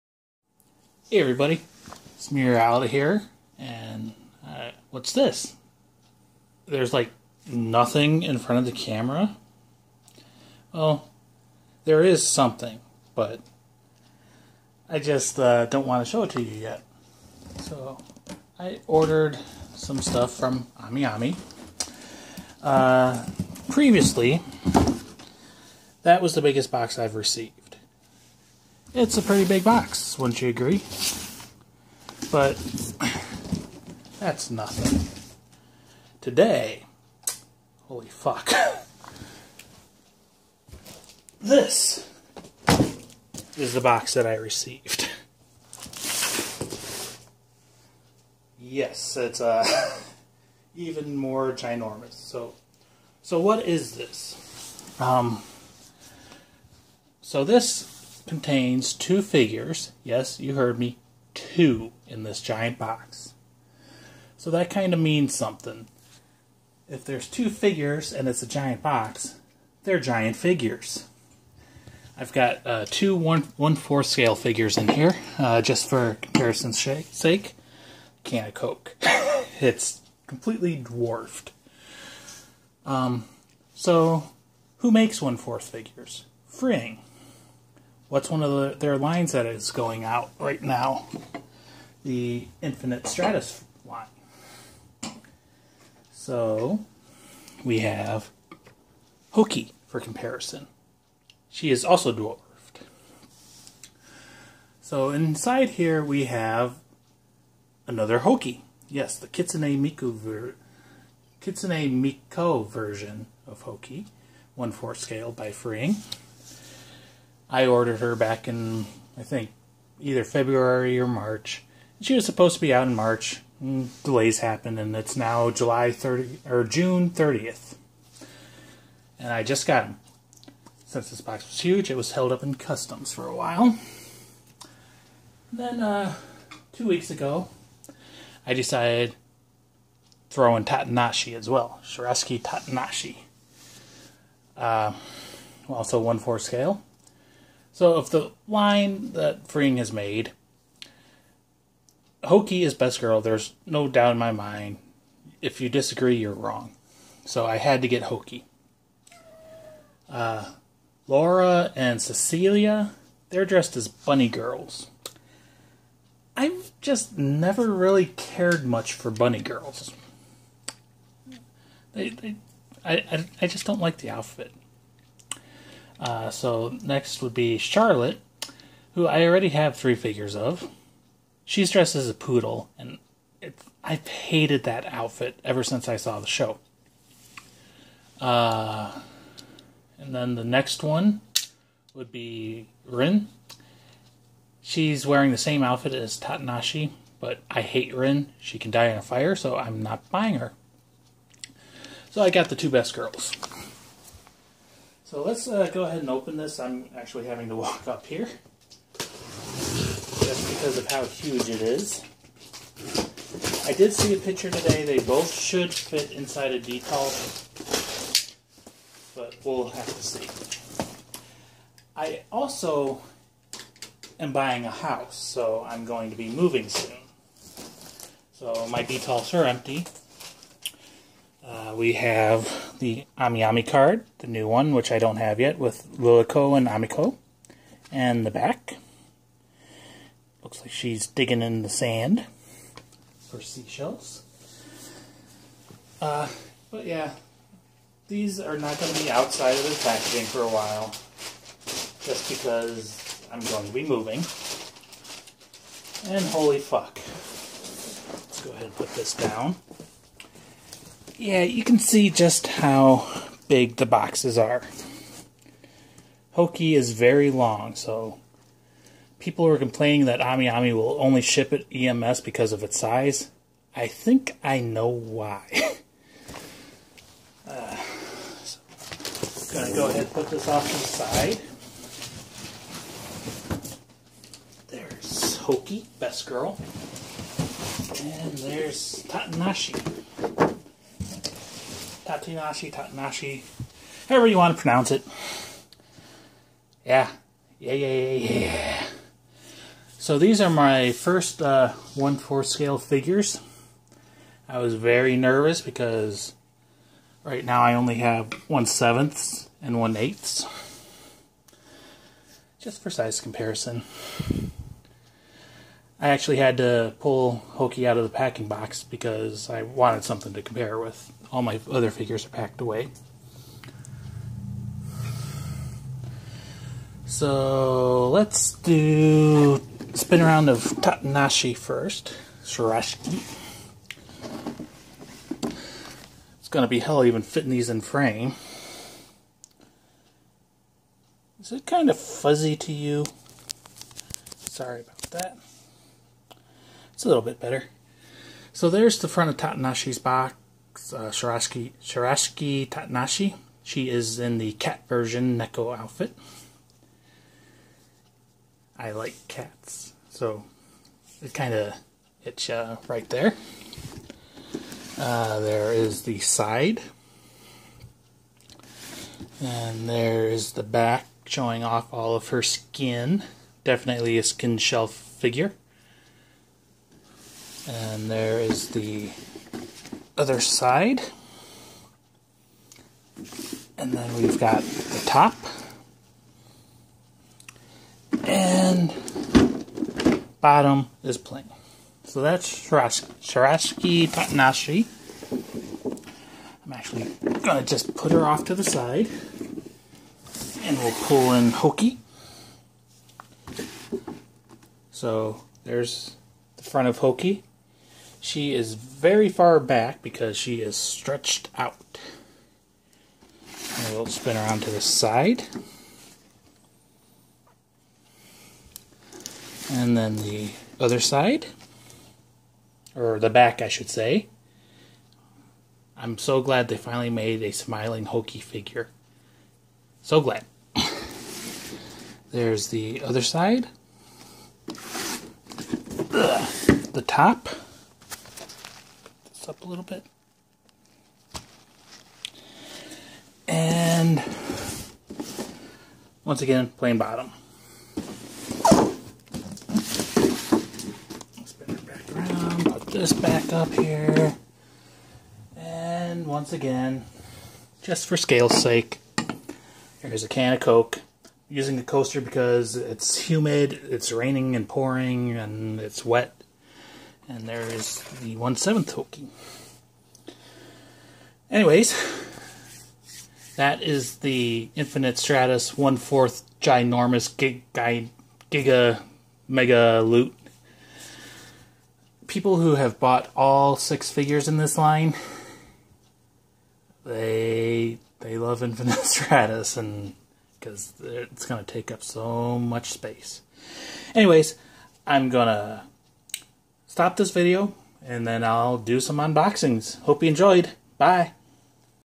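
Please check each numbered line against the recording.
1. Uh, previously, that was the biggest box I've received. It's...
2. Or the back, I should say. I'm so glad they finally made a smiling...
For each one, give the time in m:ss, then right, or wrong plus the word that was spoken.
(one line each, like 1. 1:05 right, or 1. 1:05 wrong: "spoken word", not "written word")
1. 0:22 right
2. 7:02 right.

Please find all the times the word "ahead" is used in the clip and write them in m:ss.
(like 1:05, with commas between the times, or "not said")
3:25, 4:18, 4:39.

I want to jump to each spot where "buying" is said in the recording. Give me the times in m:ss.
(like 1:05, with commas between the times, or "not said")
3:20, 3:44.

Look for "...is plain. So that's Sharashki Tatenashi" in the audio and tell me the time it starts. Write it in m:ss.
6:31.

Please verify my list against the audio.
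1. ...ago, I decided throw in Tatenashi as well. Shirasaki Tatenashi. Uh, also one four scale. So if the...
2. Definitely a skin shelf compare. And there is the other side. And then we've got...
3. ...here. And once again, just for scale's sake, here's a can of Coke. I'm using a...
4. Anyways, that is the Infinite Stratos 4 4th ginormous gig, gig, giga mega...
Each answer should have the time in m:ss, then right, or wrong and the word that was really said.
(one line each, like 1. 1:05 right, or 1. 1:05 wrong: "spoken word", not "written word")
1. 2:17 right
2. 6:13 wrong: "figure", not "compare"
3. 7:33 right
4. 7:51 wrong: "1", not "4".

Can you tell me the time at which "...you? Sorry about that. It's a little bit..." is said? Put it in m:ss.
5:42.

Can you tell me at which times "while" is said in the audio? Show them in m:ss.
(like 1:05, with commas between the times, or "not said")
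2:13, 4:10.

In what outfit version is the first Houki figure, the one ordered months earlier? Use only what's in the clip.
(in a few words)
Kitsune Miko version.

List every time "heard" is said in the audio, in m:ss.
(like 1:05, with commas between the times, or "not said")
1:00.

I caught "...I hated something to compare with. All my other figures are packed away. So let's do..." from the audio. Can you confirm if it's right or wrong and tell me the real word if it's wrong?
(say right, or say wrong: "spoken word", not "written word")
wrong: "wanted", not "hated".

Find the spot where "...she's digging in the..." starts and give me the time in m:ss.
4:00.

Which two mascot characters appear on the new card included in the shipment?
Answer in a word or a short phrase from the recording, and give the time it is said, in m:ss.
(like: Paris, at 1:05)
Lilico and Amiko, at 3:55.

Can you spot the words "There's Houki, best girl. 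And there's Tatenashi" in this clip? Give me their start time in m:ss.
4:44.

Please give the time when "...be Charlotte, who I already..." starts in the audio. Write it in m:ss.
2:57.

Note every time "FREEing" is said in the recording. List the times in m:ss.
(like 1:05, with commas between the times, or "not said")
1:26, 1:55, 2:29.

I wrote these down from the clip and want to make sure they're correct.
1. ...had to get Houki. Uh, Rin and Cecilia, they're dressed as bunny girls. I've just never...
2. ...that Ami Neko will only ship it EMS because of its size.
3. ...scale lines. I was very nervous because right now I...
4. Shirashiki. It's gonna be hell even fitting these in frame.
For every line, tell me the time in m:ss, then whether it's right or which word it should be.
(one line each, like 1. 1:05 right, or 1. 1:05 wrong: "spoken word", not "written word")
1. 2:37 wrong: "Laura", not "Rin"
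2. 4:30 wrong: "Ami", not "Neko"
3. 5:02 wrong: "figures", not "lines"
4. 5:32 right.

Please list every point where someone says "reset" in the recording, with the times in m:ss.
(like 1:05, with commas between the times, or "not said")
not said.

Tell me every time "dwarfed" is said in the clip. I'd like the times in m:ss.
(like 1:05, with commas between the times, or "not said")
1:20, 1:42.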